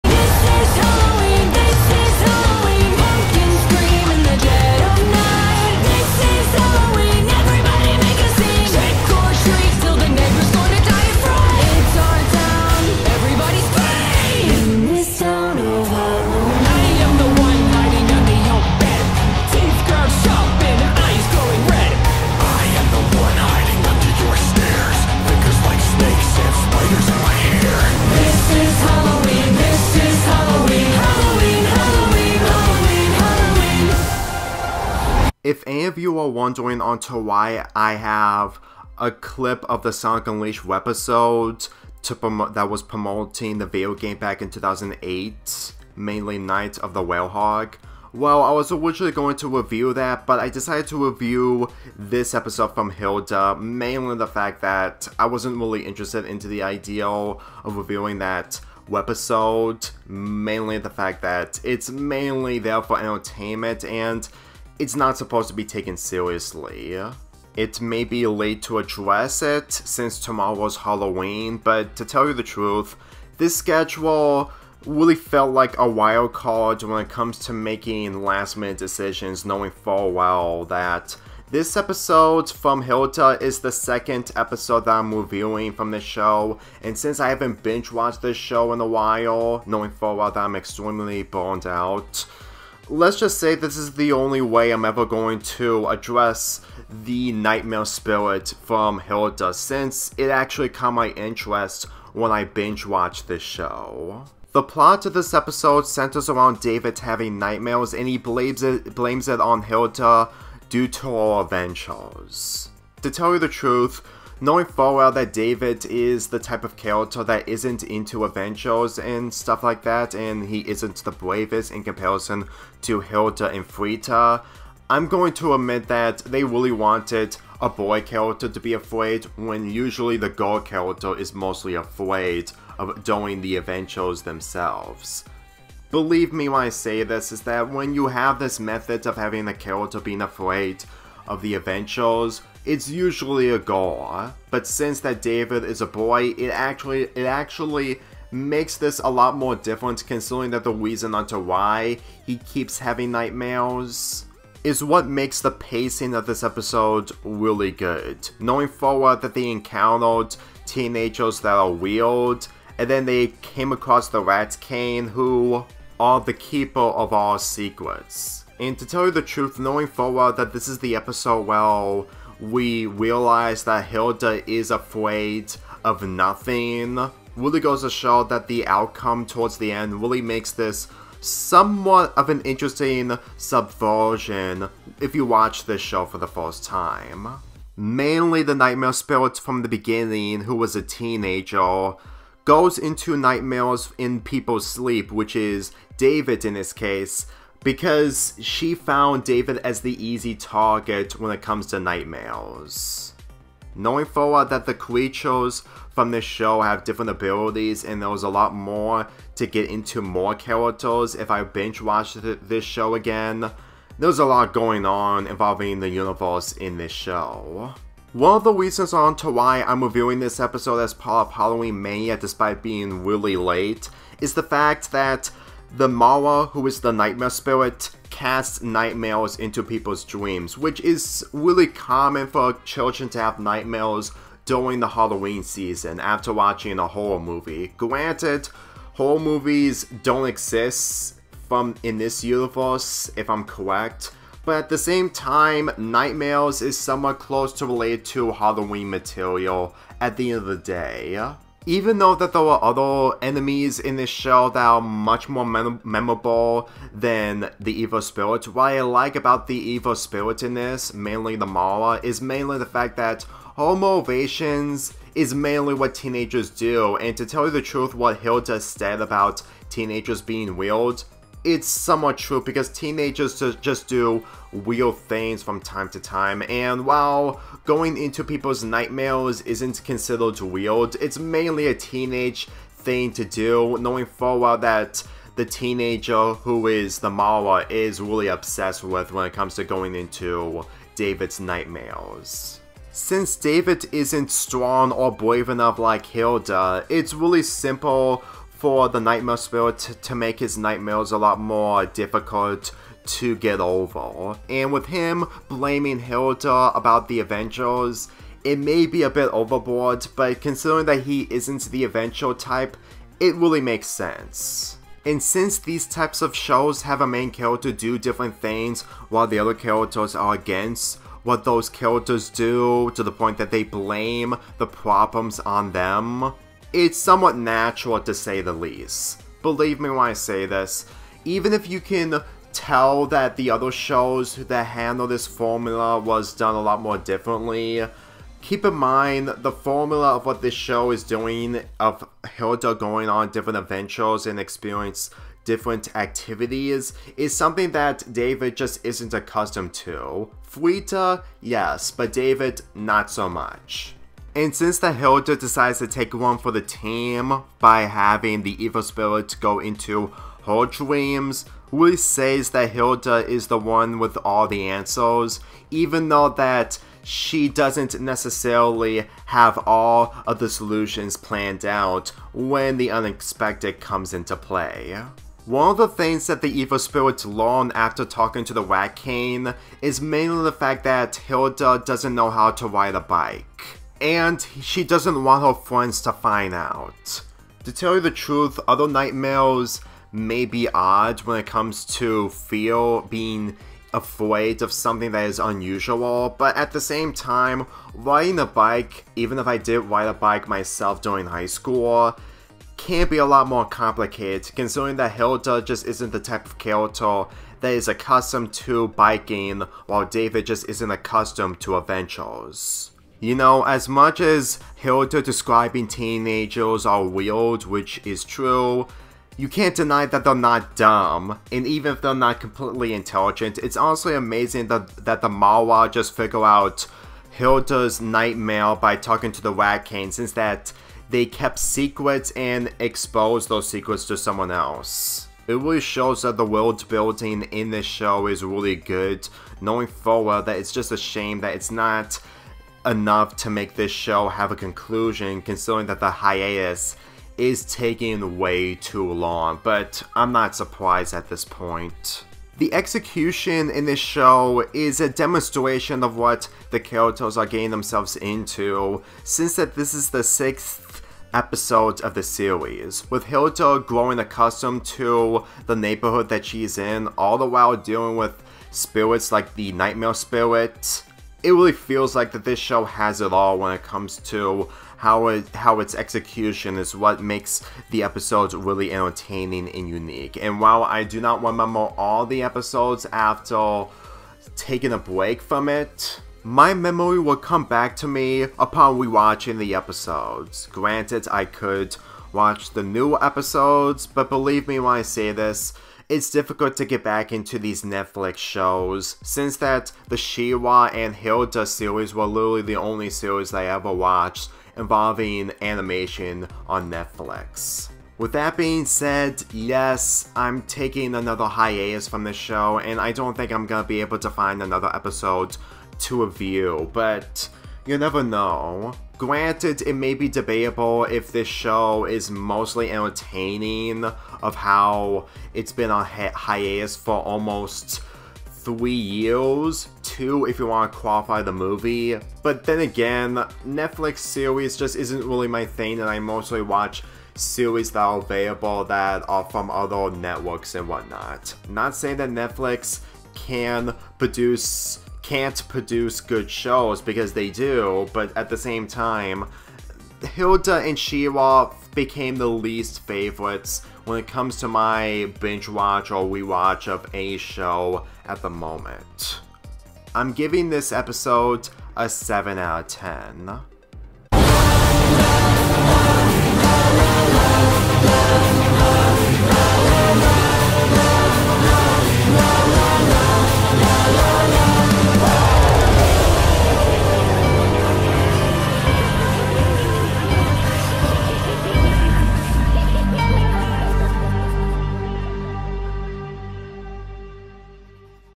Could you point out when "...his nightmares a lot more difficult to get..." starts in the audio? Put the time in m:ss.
5:00.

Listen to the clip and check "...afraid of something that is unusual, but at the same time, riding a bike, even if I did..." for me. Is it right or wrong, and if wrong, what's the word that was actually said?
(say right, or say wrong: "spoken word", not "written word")
right.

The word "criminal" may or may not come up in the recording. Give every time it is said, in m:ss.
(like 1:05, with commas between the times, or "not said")
not said.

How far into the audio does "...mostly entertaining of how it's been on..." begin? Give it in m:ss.
8:42.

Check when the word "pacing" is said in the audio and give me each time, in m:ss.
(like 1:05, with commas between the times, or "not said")
2:35.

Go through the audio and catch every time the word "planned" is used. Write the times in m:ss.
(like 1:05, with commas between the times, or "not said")
6:11.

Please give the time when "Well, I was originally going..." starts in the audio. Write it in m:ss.
0:48.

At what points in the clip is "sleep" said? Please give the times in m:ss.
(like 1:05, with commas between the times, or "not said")
3:14.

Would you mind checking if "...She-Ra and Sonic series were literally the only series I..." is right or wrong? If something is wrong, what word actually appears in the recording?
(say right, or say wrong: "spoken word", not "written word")
wrong: "Hilda", not "Sonic".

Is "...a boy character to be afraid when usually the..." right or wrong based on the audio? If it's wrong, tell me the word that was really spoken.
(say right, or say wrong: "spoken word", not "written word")
right.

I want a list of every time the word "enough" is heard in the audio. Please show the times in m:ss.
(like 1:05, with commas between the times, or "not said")
4:55, 7:22.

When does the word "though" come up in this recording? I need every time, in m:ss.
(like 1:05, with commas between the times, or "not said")
4:11, 6:06.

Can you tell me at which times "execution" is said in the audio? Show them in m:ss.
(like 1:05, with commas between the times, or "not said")
7:32, 7:55.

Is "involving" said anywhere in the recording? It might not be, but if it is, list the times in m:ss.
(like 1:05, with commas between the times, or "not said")
3:35, 8:24.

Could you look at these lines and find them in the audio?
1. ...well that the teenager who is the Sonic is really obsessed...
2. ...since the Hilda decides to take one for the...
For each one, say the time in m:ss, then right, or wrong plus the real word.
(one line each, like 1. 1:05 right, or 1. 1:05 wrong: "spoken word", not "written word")
1. 4:44 wrong: "Mara", not "Sonic"
2. 5:54 right.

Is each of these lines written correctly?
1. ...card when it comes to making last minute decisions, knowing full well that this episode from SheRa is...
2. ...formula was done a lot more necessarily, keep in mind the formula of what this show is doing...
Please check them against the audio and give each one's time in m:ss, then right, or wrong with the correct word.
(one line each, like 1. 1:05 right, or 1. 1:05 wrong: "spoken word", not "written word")
1. 1:16 wrong: "Hilda", not "SheRa"
2. 5:35 wrong: "differently", not "necessarily".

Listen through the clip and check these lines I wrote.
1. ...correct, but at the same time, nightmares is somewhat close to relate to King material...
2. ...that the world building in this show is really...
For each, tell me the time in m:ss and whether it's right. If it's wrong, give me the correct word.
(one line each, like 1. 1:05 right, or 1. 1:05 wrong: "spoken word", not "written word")
1. 4:03 wrong: "Halloween", not "King"
2. 7:16 right.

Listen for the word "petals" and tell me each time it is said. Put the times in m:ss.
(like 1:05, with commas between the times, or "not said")
not said.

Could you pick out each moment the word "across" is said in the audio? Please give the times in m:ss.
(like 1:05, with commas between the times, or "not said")
2:43.